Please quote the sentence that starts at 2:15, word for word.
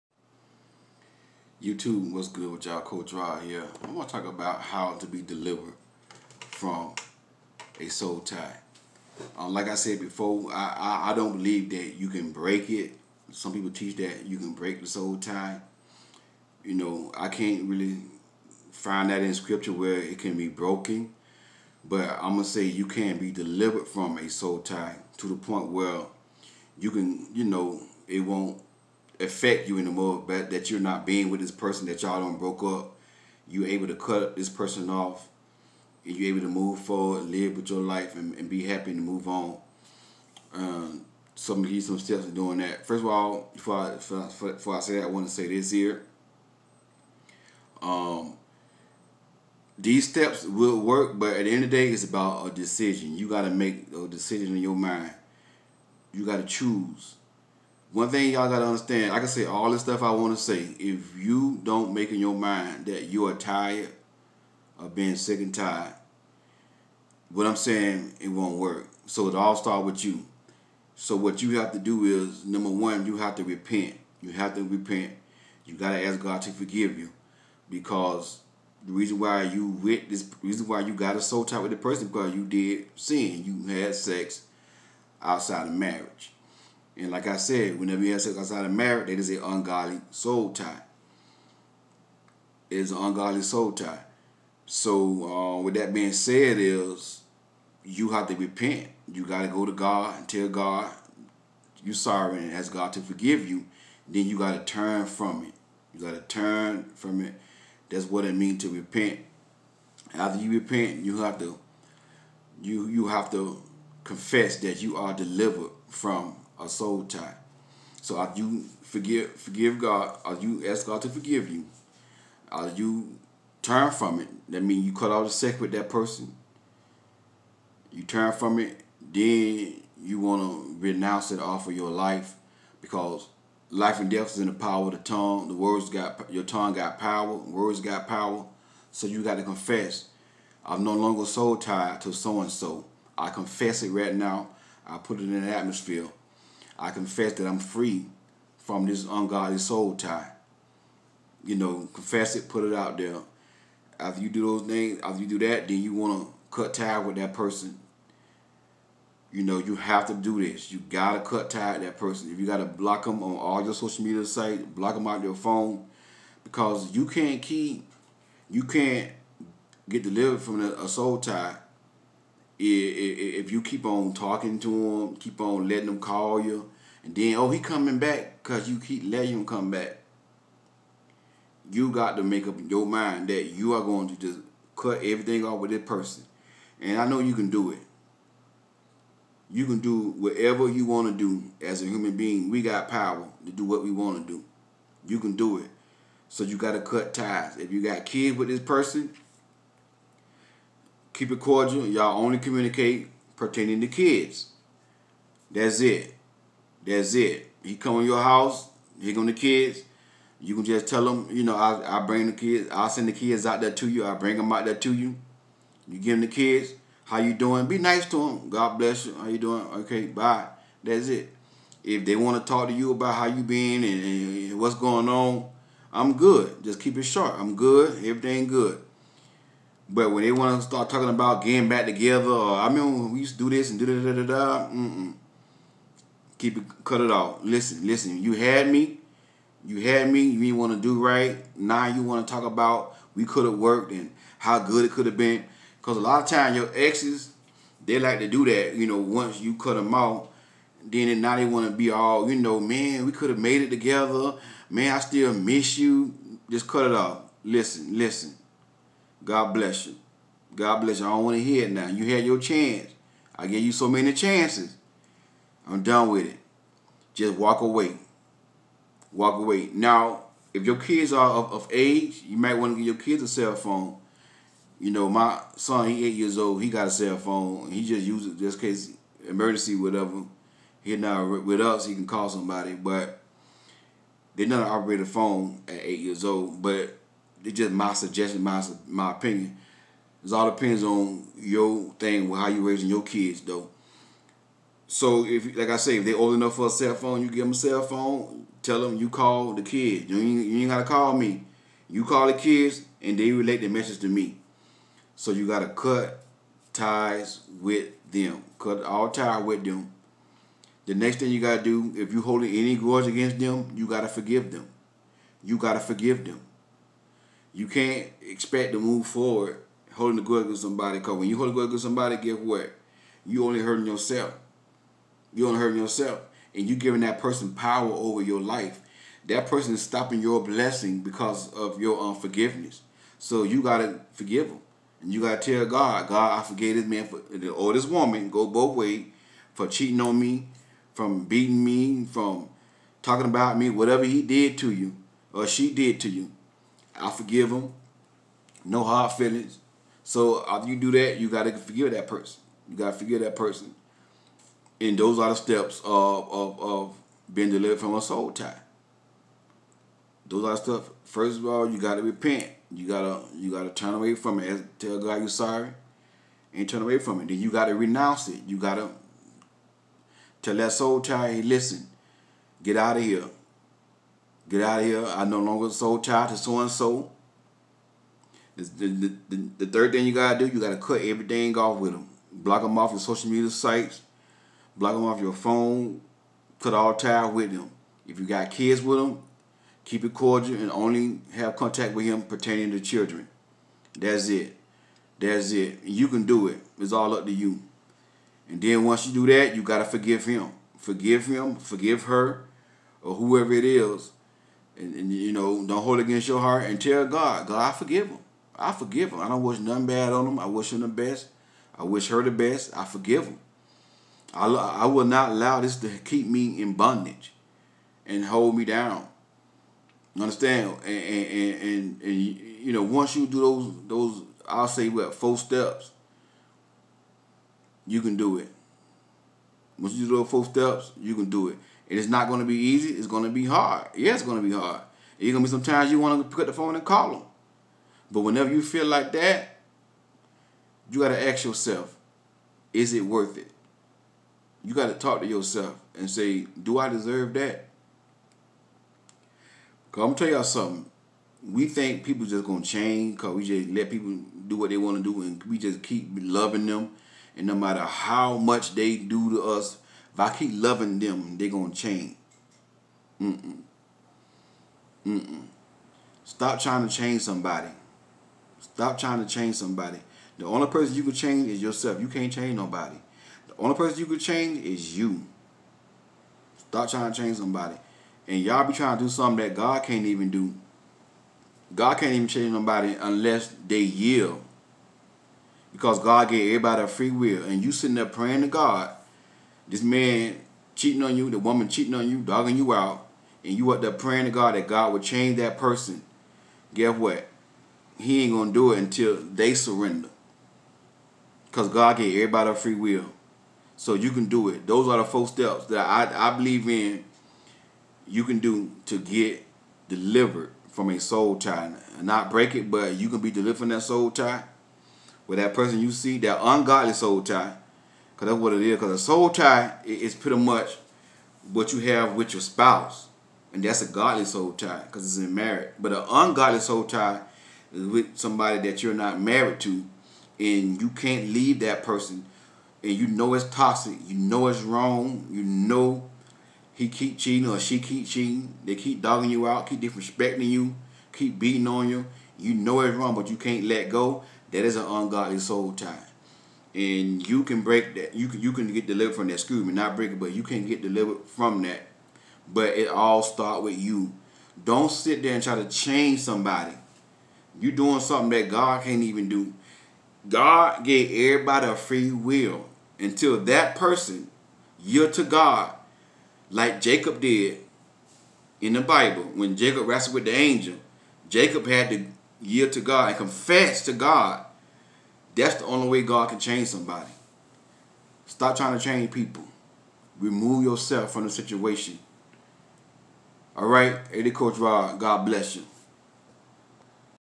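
The words got your tongue got power.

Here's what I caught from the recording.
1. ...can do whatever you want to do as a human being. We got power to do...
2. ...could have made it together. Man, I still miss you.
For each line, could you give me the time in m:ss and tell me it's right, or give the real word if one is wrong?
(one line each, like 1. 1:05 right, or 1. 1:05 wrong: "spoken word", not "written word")
1. 3:09 right
2. 4:13 right.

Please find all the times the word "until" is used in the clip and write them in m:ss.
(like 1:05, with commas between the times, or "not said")
8:18, 9:22.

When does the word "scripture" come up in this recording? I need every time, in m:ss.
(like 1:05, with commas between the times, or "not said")
0:19.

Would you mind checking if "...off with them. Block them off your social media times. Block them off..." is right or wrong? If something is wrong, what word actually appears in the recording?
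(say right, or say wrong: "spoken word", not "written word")
wrong: "sites", not "times".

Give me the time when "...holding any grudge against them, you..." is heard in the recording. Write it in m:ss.
5:12.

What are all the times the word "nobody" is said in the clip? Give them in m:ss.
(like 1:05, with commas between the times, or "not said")
7:52, 8:02.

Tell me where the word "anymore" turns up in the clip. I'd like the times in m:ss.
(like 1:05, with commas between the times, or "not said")
0:29.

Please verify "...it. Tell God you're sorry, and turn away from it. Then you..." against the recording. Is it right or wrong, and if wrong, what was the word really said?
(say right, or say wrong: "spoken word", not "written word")
right.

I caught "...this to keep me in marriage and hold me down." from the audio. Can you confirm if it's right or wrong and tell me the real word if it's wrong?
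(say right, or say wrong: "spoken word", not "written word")
wrong: "bondage", not "marriage".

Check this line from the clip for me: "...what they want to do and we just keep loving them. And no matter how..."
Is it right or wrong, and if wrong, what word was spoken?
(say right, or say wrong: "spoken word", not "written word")
right.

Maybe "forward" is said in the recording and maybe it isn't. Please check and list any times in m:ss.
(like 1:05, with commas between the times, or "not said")
0:36, 5:19.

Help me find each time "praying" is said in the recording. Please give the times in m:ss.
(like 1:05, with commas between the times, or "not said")
8:08, 8:13.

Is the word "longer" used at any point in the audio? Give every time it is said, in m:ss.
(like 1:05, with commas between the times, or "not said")
2:20, 6:15.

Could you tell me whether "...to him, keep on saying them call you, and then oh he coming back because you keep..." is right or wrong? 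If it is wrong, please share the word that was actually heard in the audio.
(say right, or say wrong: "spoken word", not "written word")
wrong: "letting", not "saying".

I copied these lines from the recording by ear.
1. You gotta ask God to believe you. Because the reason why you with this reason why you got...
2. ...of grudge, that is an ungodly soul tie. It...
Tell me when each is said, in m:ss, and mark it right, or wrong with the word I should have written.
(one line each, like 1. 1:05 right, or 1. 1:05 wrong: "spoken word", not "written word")
1. 1:15 wrong: "forgive", not "believe"
2. 1:28 wrong: "marriage", not "grudge".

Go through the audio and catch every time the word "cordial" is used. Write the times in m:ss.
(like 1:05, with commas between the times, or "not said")
3:21, 6:30.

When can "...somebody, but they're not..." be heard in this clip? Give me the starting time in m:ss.
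4:42.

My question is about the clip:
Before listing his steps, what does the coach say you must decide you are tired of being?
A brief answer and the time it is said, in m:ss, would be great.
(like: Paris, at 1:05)
sick and tired, at 1:05.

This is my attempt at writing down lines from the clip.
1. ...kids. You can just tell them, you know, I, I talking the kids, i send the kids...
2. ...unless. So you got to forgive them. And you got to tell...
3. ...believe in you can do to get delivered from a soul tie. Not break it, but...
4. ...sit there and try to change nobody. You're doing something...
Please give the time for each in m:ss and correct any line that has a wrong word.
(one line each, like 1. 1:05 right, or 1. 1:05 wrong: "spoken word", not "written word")
1. 3:29 wrong: "bring", not "talking"
2. 5:31 wrong: "unforgiveness", not "unless"
3. 8:26 right
4. 9:14 wrong: "somebody", not "nobody".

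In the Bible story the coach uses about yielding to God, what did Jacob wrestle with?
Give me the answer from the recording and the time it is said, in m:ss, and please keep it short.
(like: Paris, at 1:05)
the angel, at 9:30.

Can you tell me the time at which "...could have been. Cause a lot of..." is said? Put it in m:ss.
4:04.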